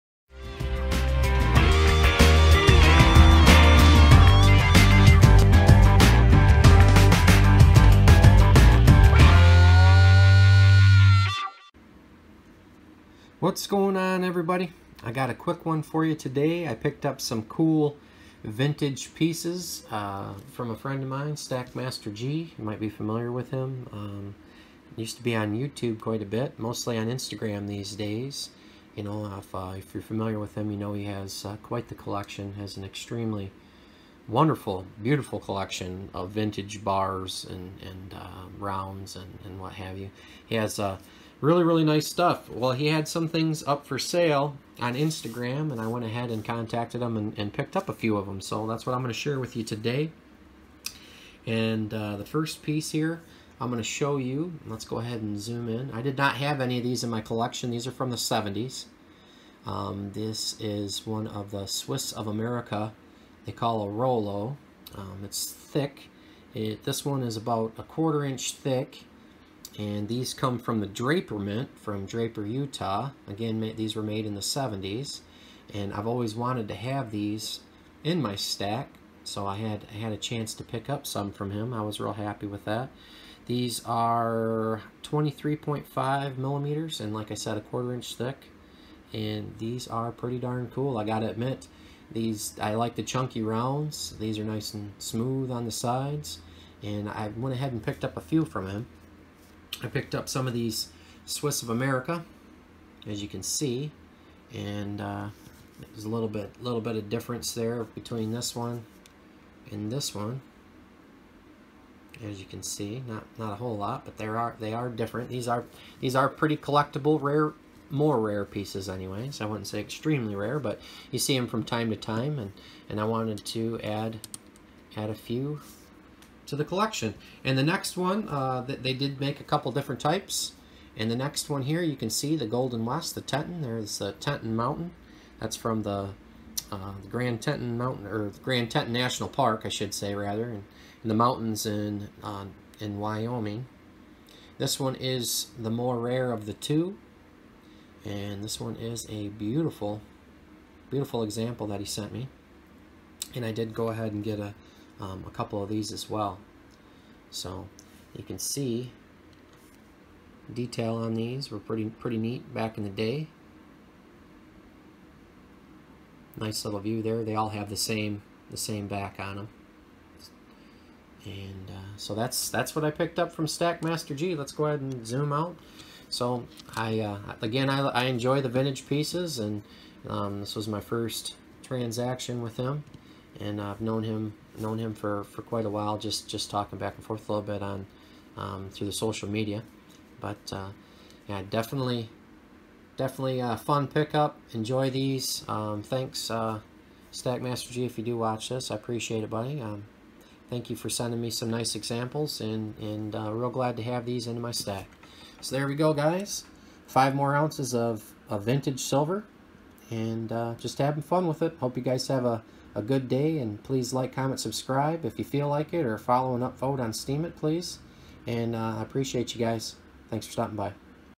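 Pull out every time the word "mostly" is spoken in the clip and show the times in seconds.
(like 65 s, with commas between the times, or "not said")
26 s.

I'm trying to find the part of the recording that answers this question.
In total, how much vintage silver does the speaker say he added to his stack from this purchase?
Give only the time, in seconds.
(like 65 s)
206 s.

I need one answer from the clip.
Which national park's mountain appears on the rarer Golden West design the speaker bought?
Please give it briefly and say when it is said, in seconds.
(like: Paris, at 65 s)
Grand Teton National Park, at 138 s.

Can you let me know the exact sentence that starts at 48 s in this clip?
So that's what I'm going to share with you today.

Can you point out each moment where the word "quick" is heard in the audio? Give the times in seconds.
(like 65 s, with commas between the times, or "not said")
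15 s.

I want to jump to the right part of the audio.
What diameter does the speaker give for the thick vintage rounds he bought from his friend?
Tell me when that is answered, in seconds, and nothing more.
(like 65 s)
85 s.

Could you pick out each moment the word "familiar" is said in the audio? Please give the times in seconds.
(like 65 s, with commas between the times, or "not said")
22 s, 30 s.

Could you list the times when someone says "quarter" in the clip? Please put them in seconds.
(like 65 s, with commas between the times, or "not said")
67 s, 87 s.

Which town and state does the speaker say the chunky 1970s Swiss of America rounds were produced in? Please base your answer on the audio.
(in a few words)
Draper, Utah.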